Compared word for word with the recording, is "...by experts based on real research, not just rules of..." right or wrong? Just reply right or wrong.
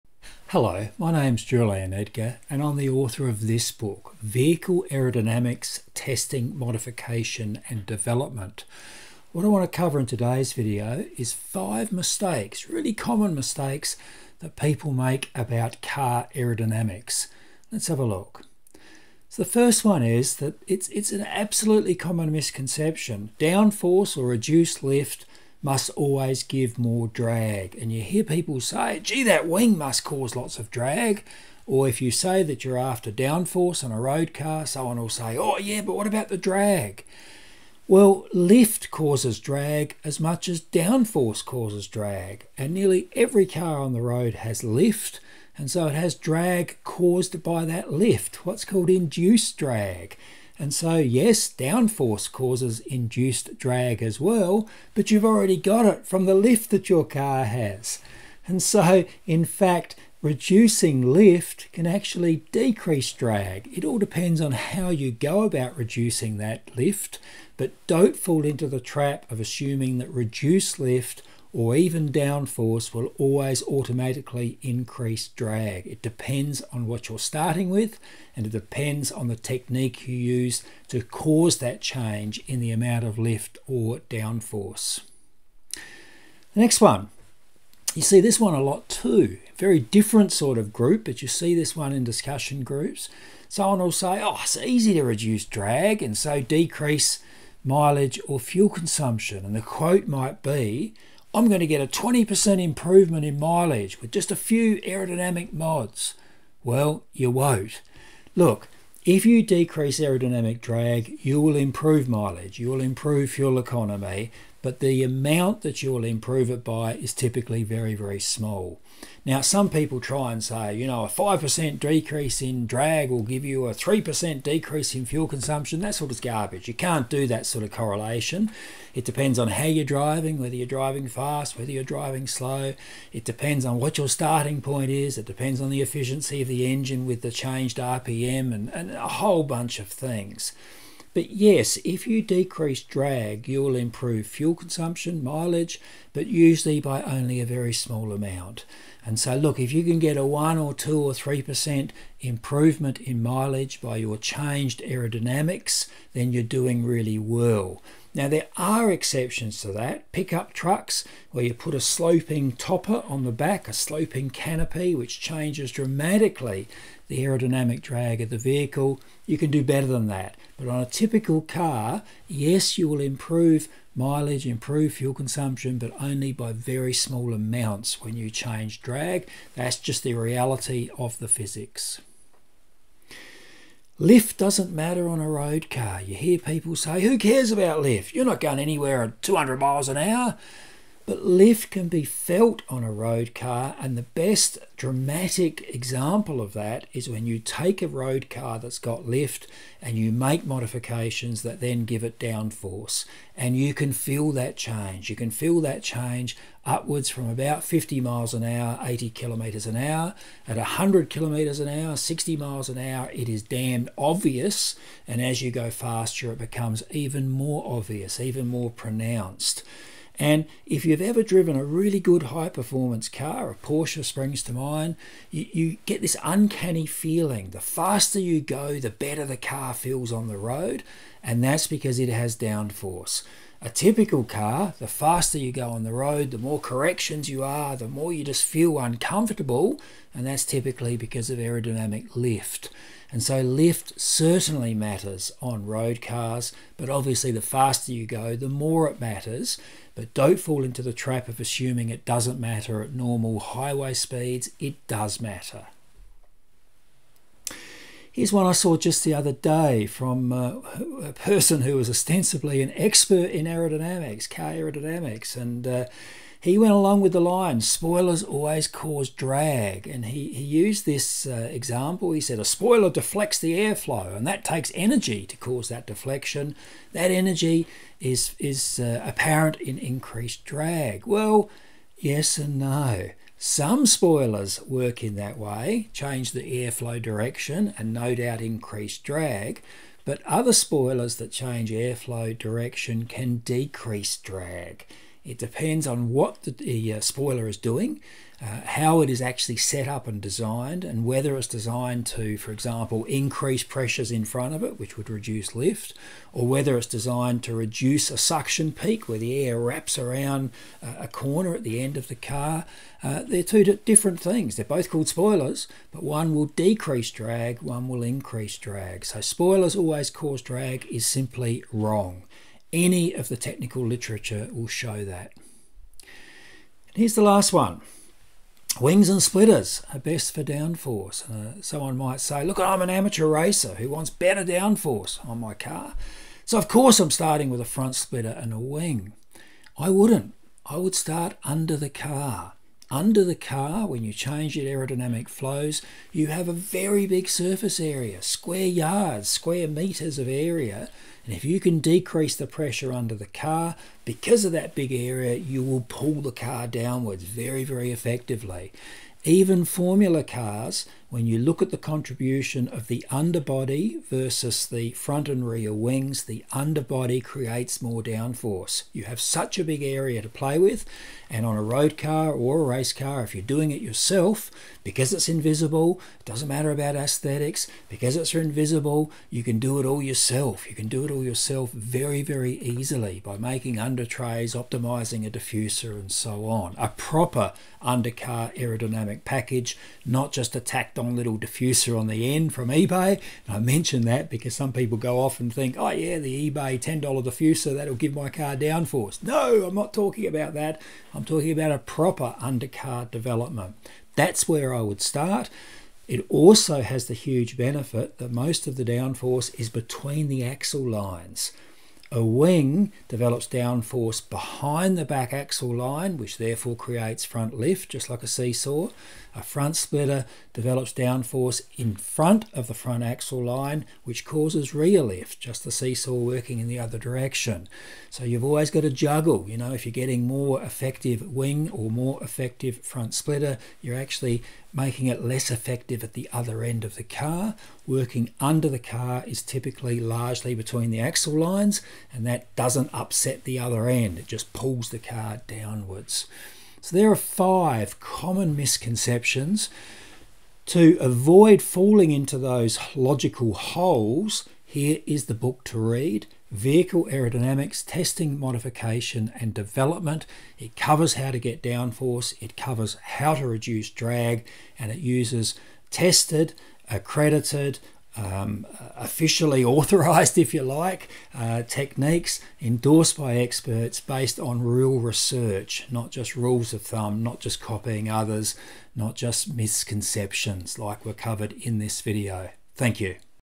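right.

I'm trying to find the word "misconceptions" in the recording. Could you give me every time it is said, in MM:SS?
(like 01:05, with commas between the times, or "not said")
00:22, 07:28, 07:59.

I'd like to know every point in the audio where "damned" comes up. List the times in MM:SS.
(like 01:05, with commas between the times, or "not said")
03:33.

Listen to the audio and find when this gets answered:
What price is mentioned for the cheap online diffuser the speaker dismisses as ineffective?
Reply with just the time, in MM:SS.
06:36.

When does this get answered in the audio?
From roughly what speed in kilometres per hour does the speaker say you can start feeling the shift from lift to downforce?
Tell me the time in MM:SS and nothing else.
03:28.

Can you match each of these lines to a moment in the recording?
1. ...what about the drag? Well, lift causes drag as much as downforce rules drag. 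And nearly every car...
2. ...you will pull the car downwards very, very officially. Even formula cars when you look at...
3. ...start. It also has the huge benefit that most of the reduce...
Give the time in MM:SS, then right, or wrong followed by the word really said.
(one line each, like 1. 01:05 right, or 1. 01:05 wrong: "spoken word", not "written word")
1. 00:35 wrong: "causes", not "rules"
2. 05:55 wrong: "effectively", not "officially"
3. 06:45 wrong: "downforce", not "reduce".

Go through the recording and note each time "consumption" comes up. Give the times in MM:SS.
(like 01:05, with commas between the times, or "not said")
01:38, 02:05, 02:24, 02:55.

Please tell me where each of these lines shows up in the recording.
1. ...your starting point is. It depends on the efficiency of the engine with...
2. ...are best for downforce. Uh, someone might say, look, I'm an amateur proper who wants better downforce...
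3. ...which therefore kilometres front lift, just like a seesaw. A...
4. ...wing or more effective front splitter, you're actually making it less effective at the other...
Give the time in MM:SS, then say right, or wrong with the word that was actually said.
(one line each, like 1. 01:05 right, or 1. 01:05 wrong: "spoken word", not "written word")
1. 02:13 right
2. 05:29 wrong: "racer", not "proper"
3. 06:56 wrong: "creates", not "kilometres"
4. 07:11 right.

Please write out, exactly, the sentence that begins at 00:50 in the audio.
And so, yes, downforce causes induced drag as well, but you've already got it from the lift that your car has.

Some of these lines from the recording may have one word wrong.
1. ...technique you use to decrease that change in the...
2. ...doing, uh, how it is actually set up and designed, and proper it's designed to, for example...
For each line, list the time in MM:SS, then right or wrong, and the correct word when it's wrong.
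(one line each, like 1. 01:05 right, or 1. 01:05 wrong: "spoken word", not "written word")
1. 01:19 wrong: "cause", not "decrease"
2. 04:57 wrong: "whether", not "proper".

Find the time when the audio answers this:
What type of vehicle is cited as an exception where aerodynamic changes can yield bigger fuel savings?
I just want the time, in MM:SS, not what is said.
02:40.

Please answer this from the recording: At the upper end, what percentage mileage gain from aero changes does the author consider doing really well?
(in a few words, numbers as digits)
3%.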